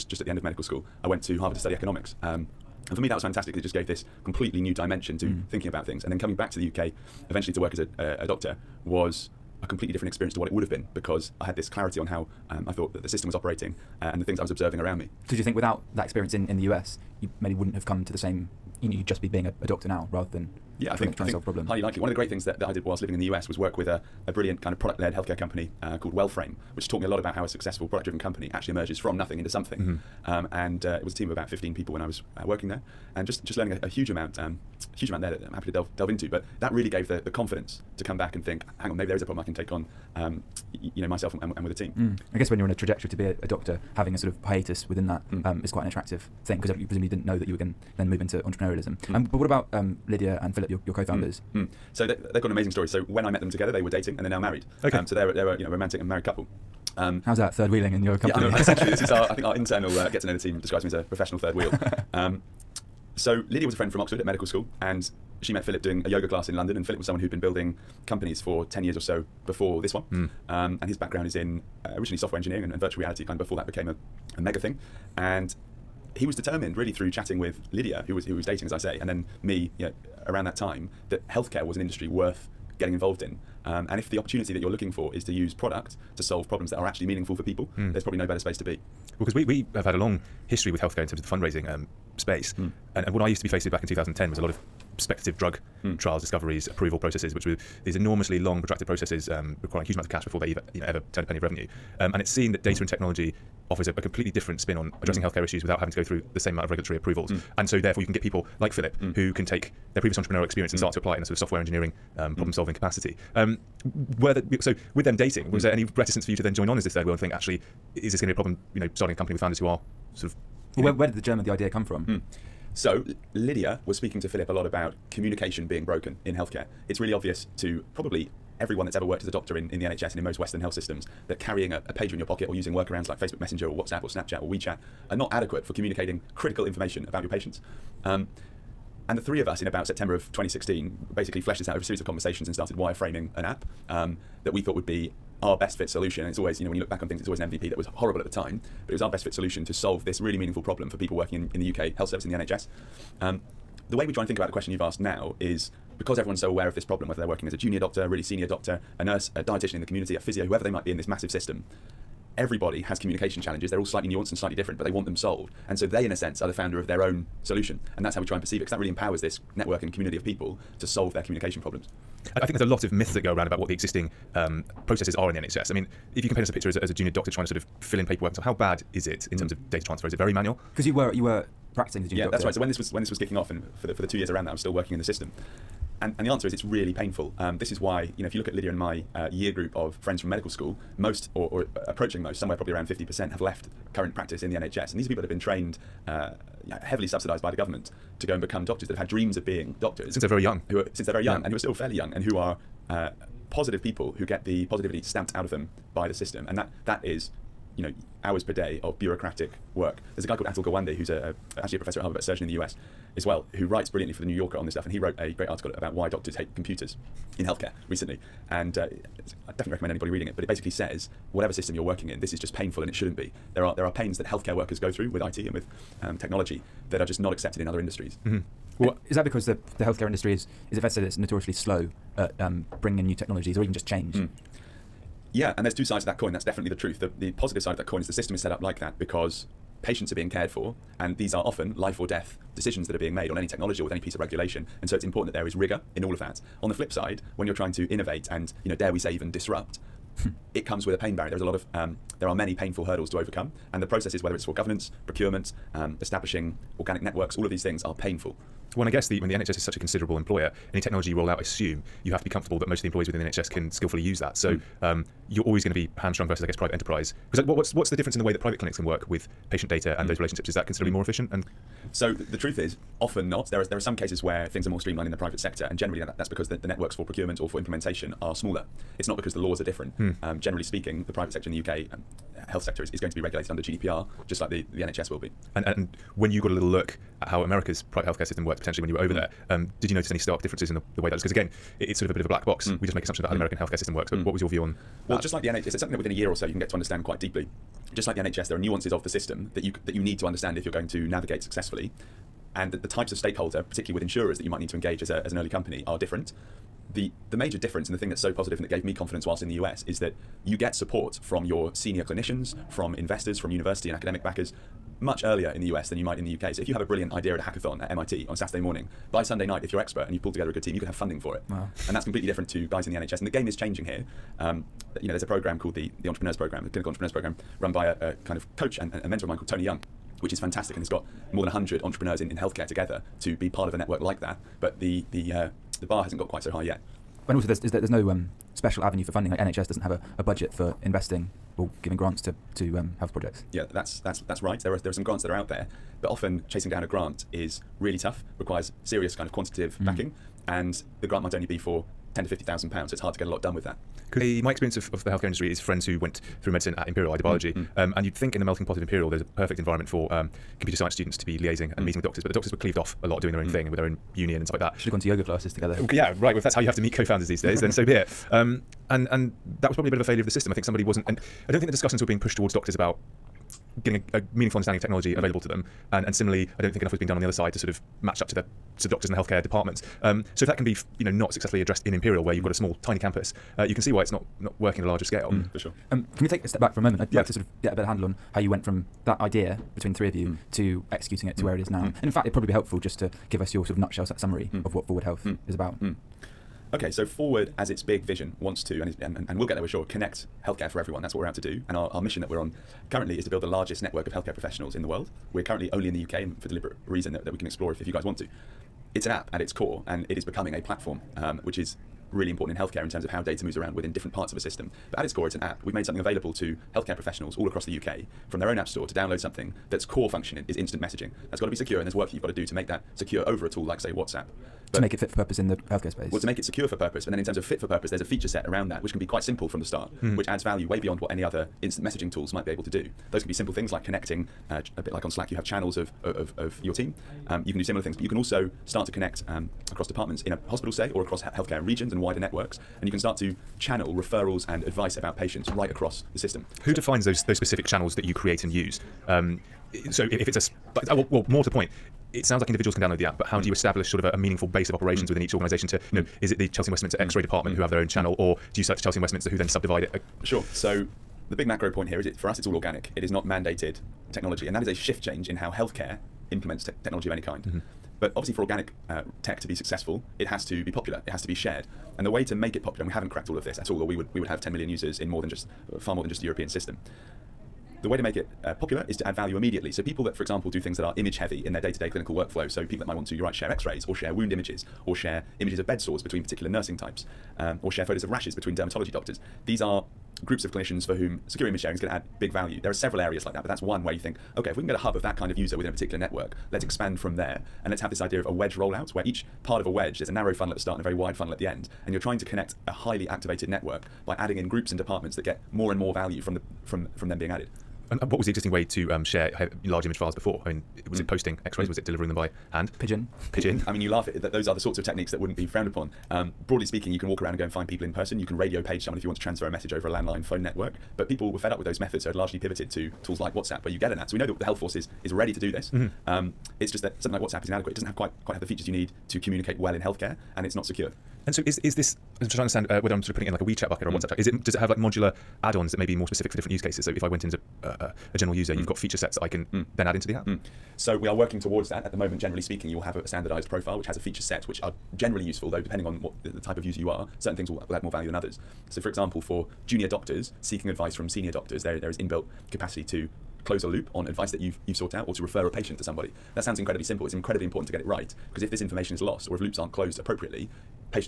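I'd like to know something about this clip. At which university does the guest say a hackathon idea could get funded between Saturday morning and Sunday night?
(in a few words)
MIT.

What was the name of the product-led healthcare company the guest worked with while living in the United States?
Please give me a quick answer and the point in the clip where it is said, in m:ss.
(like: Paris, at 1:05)
Wellframe, at 0:26.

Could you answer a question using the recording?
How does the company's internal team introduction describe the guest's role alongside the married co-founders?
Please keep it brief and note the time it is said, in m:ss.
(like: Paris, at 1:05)
professional third wheel, at 1:01.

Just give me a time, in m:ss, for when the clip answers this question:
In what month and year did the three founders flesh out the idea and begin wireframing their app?
2:19.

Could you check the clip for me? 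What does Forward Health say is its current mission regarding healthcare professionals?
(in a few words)
largest network of healthcare professionals.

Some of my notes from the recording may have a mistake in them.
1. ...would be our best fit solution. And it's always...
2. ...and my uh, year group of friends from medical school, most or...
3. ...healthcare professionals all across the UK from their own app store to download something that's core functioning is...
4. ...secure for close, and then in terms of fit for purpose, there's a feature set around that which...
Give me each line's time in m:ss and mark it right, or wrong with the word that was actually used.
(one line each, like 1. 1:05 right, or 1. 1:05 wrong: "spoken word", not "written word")
1. 2:24 right
2. 3:08 right
3. 6:56 right
4. 7:06 wrong: "purpose", not "close".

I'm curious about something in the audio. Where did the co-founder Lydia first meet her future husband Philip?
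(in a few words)
a yoga class in London.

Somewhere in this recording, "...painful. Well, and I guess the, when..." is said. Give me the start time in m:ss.
4:17.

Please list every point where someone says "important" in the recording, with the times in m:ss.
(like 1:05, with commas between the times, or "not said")
4:05, 6:52, 9:17.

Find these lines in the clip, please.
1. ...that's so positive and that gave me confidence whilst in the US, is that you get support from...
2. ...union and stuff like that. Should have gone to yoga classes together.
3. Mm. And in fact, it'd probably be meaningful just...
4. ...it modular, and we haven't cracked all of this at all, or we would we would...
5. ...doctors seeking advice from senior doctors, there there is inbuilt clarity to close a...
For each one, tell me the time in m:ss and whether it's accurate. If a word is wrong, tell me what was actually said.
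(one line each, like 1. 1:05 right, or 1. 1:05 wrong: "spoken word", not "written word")
1. 5:08 right
2. 6:04 right
3. 6:31 wrong: "helpful", not "meaningful"
4. 7:52 wrong: "popular", not "modular"
5. 9:09 wrong: "capacity", not "clarity".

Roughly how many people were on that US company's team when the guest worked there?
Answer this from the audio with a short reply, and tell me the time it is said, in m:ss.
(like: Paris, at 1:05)
15, at 0:31.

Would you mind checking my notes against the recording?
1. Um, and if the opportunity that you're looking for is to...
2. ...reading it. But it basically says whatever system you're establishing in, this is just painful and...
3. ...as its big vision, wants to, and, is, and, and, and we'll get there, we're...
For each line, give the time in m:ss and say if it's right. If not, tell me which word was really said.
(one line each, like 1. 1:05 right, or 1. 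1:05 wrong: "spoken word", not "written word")
1. 1:23 right
2. 3:40 wrong: "working", not "establishing"
3. 6:37 right.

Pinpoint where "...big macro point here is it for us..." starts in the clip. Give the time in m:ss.
7:41.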